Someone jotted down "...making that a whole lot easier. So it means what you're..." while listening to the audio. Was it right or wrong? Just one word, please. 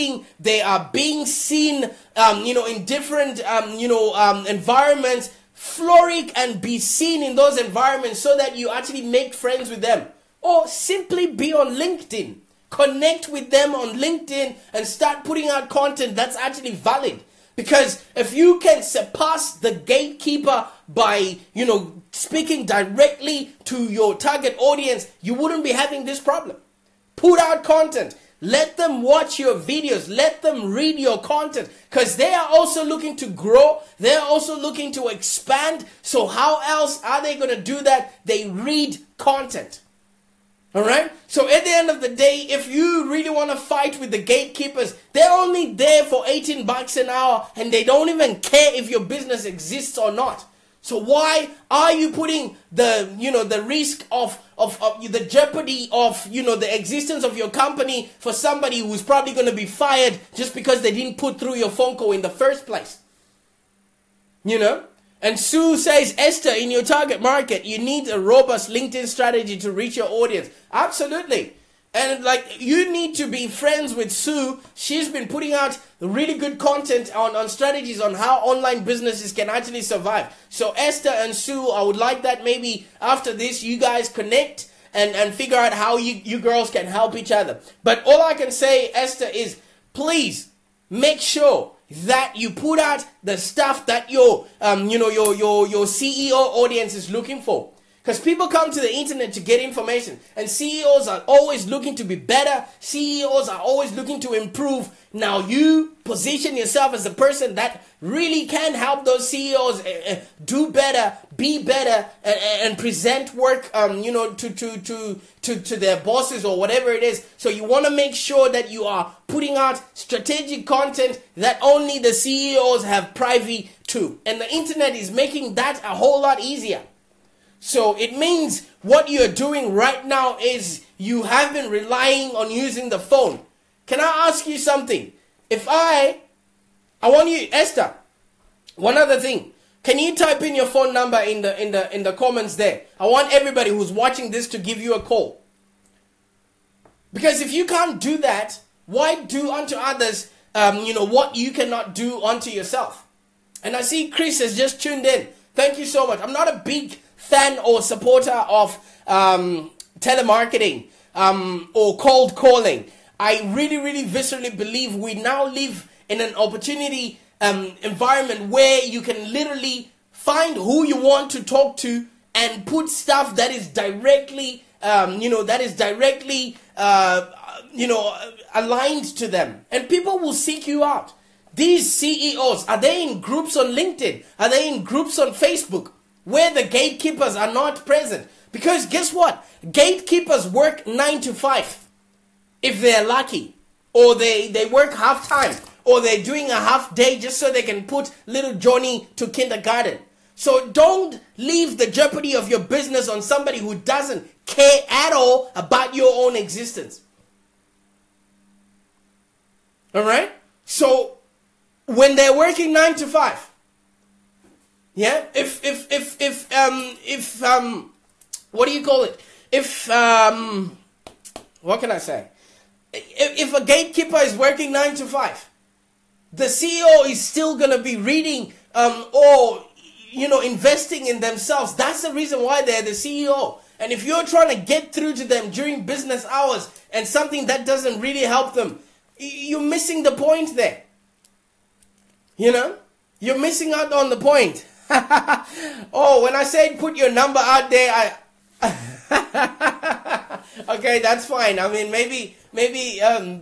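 right.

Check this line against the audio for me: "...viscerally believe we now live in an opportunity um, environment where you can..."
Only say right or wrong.
right.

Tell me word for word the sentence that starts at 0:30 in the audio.
Let them read your content because they are also looking to grow.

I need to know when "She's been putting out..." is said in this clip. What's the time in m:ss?
1:14.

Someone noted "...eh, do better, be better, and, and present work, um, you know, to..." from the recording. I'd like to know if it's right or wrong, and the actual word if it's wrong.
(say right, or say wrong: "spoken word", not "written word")
right.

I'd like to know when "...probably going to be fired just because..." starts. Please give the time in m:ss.
0:58.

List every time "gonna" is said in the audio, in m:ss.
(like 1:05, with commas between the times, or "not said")
3:47.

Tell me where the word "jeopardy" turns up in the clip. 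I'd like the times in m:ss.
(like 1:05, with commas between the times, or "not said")
0:55, 3:21.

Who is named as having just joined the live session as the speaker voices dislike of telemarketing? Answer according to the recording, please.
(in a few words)
Chris.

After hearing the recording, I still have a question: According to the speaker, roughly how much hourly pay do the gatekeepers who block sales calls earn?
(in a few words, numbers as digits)
$18 an hour.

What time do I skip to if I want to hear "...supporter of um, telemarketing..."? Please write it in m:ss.
2:37.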